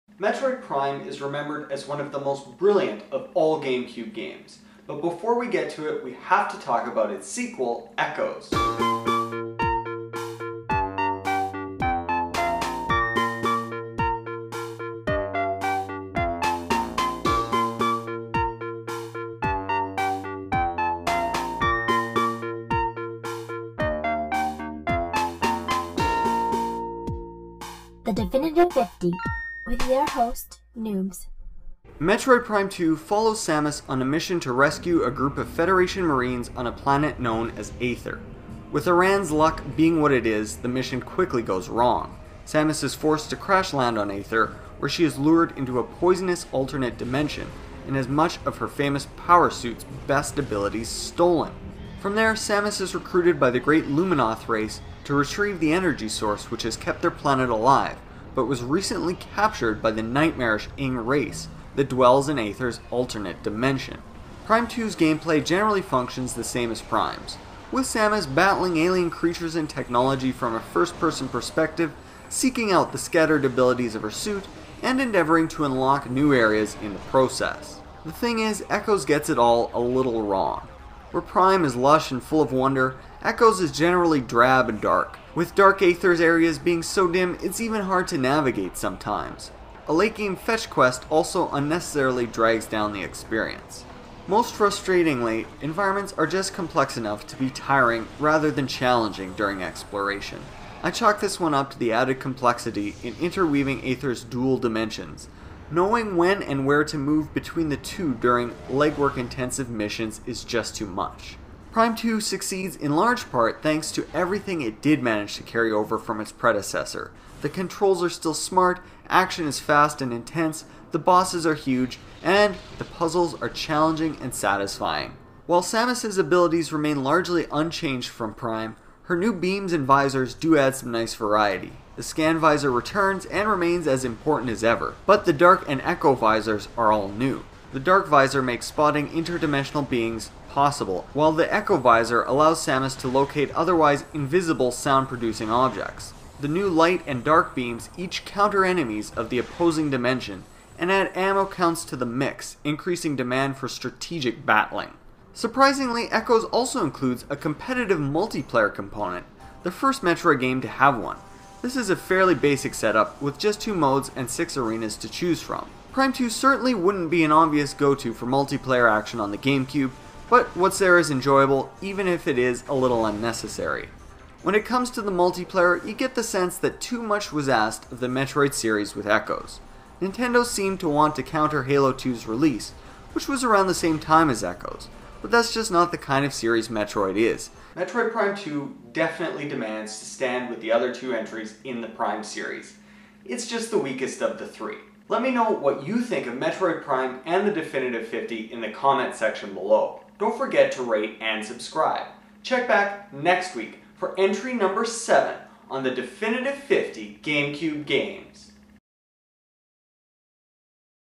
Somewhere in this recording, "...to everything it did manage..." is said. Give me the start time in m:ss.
1:53.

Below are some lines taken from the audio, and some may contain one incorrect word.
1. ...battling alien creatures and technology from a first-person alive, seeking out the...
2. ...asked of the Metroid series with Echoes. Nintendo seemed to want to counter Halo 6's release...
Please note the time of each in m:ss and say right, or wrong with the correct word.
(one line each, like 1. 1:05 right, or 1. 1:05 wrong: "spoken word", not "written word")
1. 1:08 wrong: "perspective", not "alive"
2. 2:57 wrong: "2", not "6".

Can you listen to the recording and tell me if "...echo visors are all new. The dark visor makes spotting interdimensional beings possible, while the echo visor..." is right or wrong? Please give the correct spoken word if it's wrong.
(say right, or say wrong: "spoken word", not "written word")
right.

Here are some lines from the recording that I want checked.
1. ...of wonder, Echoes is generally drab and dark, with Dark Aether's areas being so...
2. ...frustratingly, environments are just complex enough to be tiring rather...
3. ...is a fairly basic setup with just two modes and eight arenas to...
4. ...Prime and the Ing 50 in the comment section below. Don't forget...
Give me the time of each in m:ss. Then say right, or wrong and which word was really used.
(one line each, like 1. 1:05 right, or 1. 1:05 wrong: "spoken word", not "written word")
1. 1:22 right
2. 1:34 right
3. 2:41 wrong: "six", not "eight"
4. 3:16 wrong: "Definitive", not "Ing".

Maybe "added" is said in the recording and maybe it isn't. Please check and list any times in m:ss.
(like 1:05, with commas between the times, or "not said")
1:41.